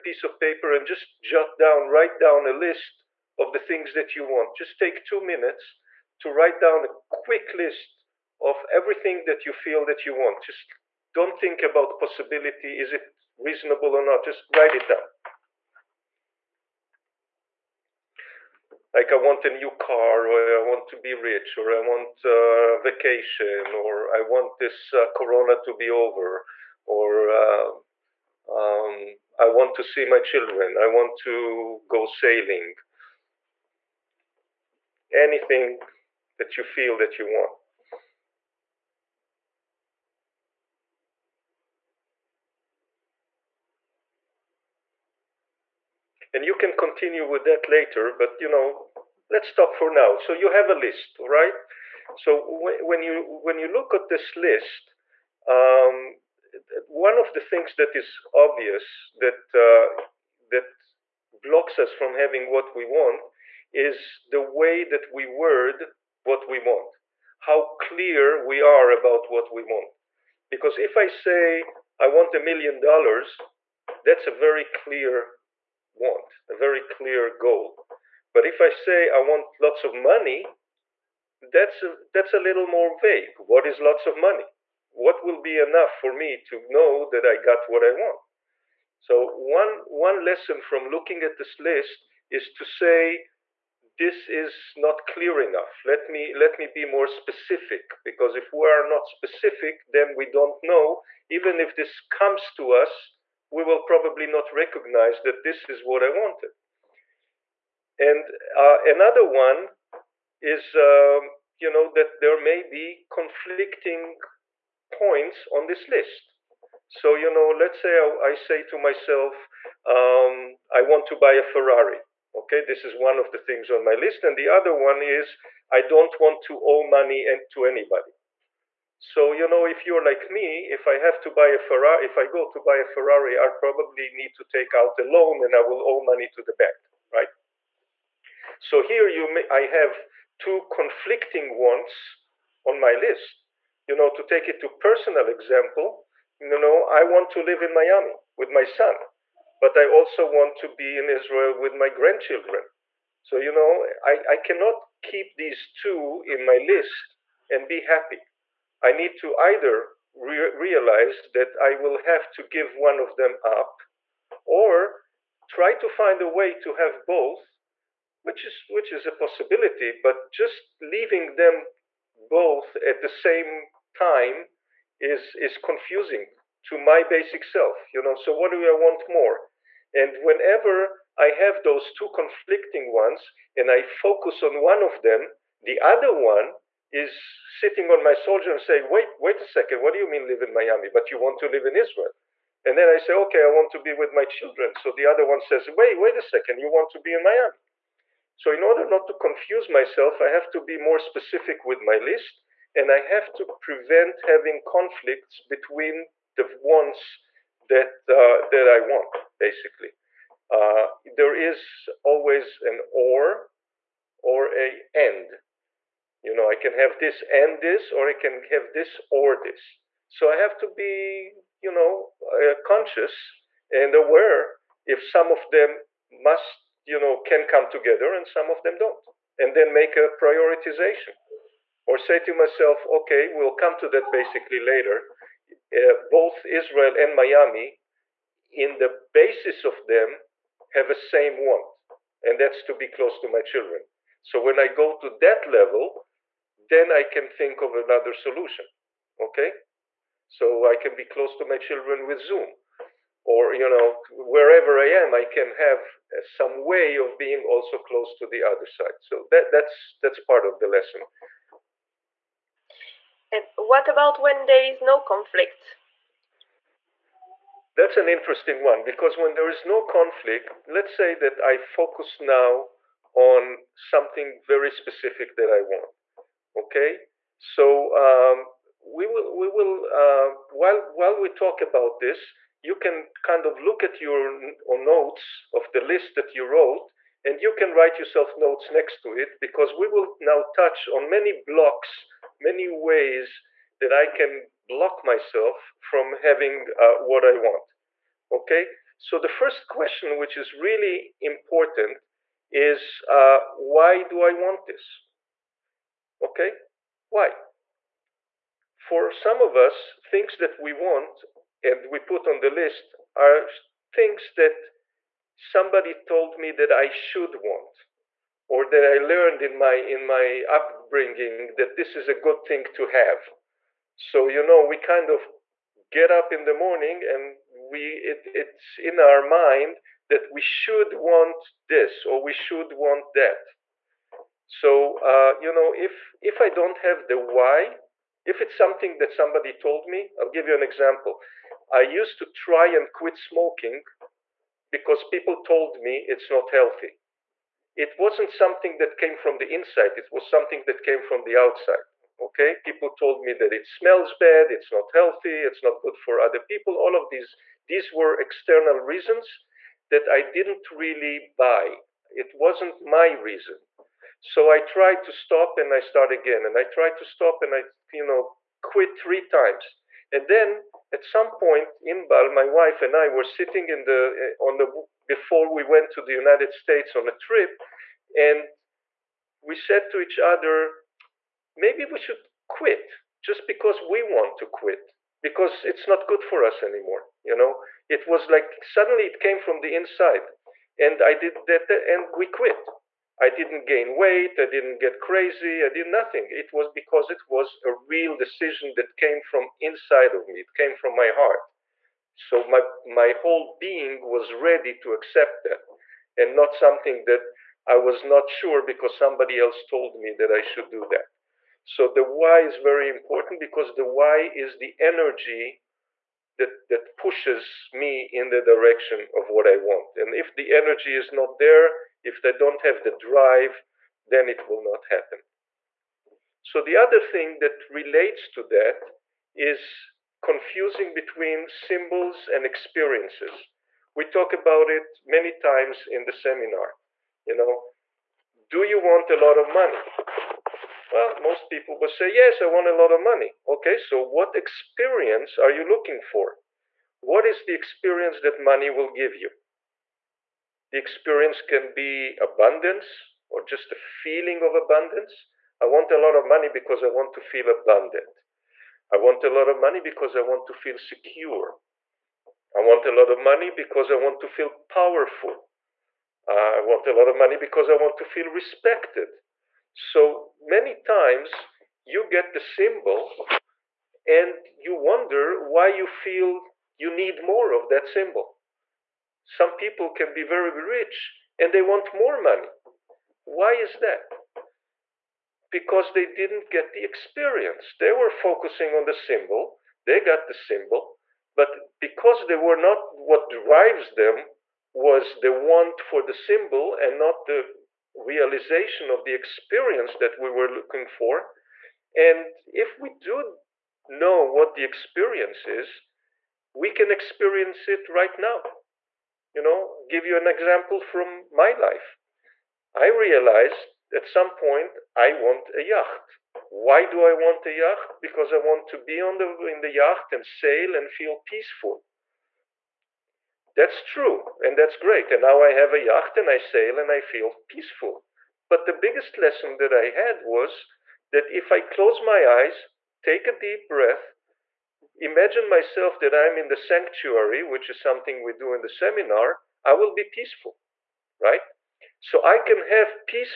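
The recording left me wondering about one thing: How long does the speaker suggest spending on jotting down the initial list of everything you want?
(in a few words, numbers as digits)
2 minutes.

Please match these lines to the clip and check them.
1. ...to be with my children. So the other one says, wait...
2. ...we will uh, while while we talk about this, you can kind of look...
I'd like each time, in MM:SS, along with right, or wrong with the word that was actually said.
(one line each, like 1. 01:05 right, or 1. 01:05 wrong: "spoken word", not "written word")
1. 03:13 right
2. 04:39 right.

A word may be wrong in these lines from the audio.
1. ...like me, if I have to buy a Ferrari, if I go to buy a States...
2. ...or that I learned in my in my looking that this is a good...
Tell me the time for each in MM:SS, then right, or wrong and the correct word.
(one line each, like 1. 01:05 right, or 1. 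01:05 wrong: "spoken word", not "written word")
1. 02:10 wrong: "Ferrari", not "States"
2. 05:18 wrong: "upbringing", not "looking".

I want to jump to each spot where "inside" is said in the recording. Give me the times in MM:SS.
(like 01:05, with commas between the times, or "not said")
05:49, 06:29, 06:39.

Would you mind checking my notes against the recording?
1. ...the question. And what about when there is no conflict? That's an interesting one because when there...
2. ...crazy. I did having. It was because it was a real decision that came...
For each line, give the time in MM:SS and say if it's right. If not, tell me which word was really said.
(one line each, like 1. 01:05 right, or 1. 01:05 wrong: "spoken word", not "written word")
1. 04:20 wrong: "lesson", not "question"
2. 06:34 wrong: "nothing", not "having".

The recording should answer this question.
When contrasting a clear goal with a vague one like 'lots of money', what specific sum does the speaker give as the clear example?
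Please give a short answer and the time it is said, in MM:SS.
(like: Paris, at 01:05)
a million dollars, at 01:12.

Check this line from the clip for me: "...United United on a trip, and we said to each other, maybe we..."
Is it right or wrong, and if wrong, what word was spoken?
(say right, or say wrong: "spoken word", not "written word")
wrong: "States", not "United".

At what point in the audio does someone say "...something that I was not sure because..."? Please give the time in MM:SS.
06:46.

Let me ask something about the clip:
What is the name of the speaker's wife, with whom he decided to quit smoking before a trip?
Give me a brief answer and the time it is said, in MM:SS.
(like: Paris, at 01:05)
Inbal, at 06:11.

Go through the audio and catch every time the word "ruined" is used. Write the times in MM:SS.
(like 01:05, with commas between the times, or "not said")
not said.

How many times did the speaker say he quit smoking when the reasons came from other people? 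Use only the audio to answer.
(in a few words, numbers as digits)
3.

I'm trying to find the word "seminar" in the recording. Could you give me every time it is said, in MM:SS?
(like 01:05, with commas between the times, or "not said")
07:16, 08:58.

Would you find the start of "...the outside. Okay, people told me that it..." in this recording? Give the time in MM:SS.
05:51.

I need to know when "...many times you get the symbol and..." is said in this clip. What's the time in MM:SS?
07:50.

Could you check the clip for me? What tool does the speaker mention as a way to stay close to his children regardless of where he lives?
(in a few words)
Zoom.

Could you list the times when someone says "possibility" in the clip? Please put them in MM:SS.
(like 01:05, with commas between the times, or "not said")
00:11, 02:49.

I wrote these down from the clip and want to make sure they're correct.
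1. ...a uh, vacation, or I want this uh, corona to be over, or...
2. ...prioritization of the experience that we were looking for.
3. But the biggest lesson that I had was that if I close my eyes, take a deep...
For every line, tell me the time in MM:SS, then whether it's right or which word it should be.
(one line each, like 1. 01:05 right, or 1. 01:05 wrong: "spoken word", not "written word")
1. 00:22 right
2. 08:17 wrong: "realization", not "prioritization"
3. 08:48 right.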